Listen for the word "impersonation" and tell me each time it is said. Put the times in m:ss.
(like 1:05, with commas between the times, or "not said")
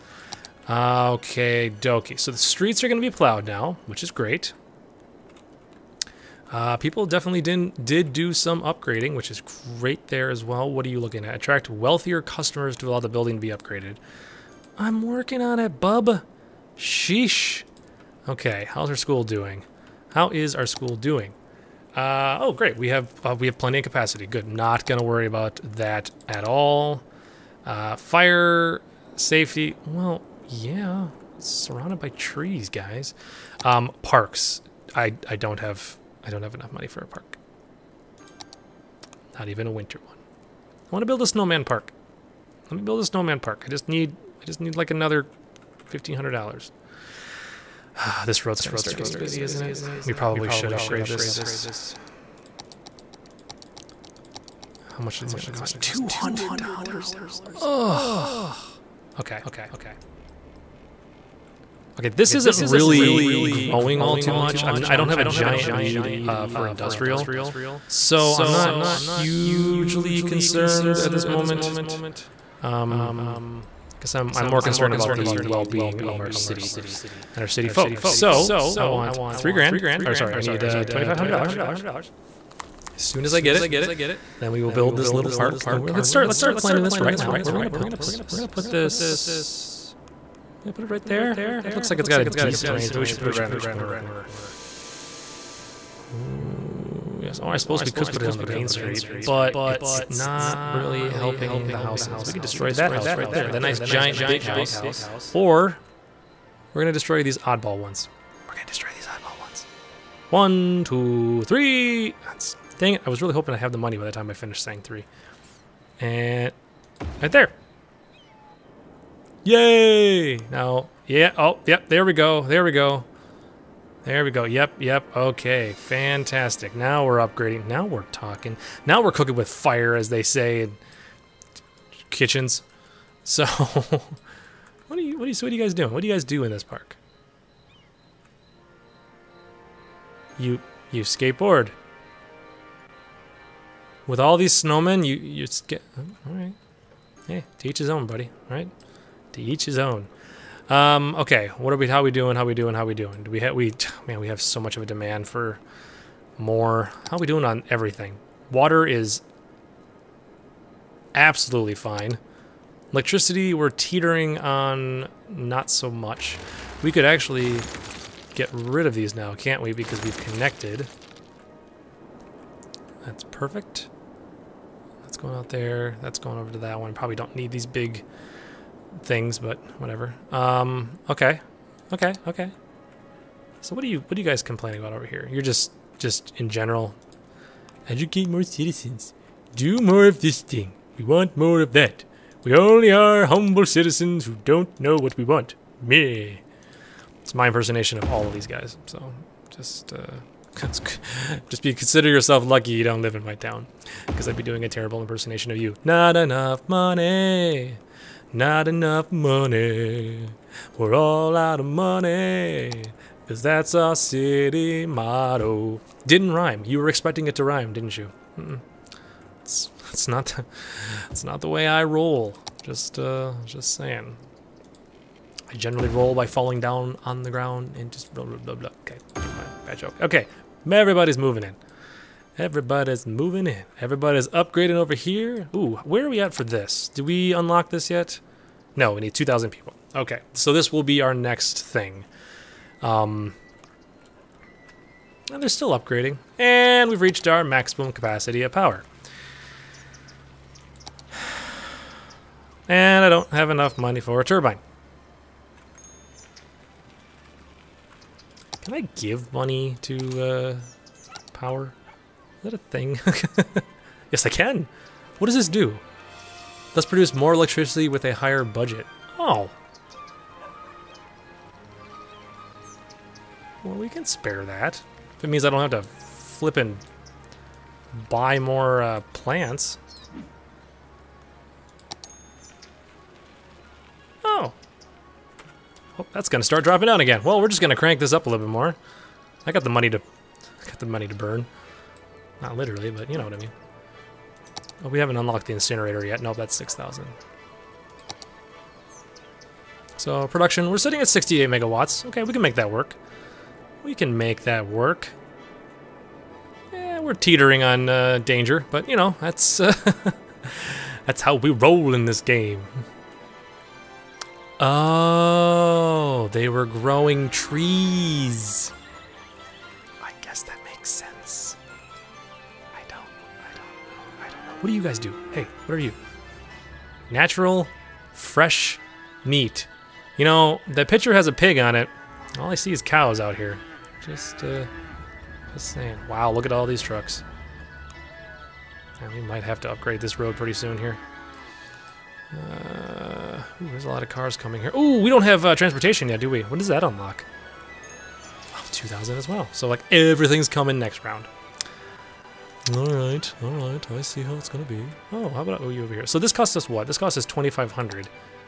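3:17, 3:25.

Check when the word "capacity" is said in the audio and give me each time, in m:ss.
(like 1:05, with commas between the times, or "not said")
0:23, 4:07.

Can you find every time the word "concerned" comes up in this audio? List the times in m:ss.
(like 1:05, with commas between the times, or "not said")
1:10, 1:14.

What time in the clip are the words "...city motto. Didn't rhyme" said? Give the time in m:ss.
3:33.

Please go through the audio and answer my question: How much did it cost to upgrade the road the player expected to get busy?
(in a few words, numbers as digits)
$200.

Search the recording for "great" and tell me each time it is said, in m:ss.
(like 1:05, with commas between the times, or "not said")
0:04, 0:09, 0:22.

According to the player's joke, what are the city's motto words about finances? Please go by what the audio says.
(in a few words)
We're all out of money.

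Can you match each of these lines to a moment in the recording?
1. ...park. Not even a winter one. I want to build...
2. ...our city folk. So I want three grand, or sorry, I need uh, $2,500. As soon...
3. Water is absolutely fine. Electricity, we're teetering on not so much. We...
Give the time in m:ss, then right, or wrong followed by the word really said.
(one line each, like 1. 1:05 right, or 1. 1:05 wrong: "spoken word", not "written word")
1. 0:37 right
2. 1:17 right
3. 2:38 right.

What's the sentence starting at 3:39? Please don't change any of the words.
It's, it's not the, it's not the way I roll.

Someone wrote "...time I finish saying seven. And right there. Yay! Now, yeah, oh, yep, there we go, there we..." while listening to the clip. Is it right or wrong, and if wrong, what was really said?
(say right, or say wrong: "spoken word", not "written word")
wrong: "three", not "seven".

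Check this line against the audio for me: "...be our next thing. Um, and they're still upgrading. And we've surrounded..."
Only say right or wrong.
wrong.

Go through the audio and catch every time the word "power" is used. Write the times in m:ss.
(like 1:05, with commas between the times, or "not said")
4:08, 4:21.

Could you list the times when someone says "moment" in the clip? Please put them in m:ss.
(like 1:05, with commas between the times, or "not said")
1:11.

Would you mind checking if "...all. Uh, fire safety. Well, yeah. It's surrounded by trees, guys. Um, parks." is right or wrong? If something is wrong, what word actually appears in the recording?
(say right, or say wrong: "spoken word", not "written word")
right.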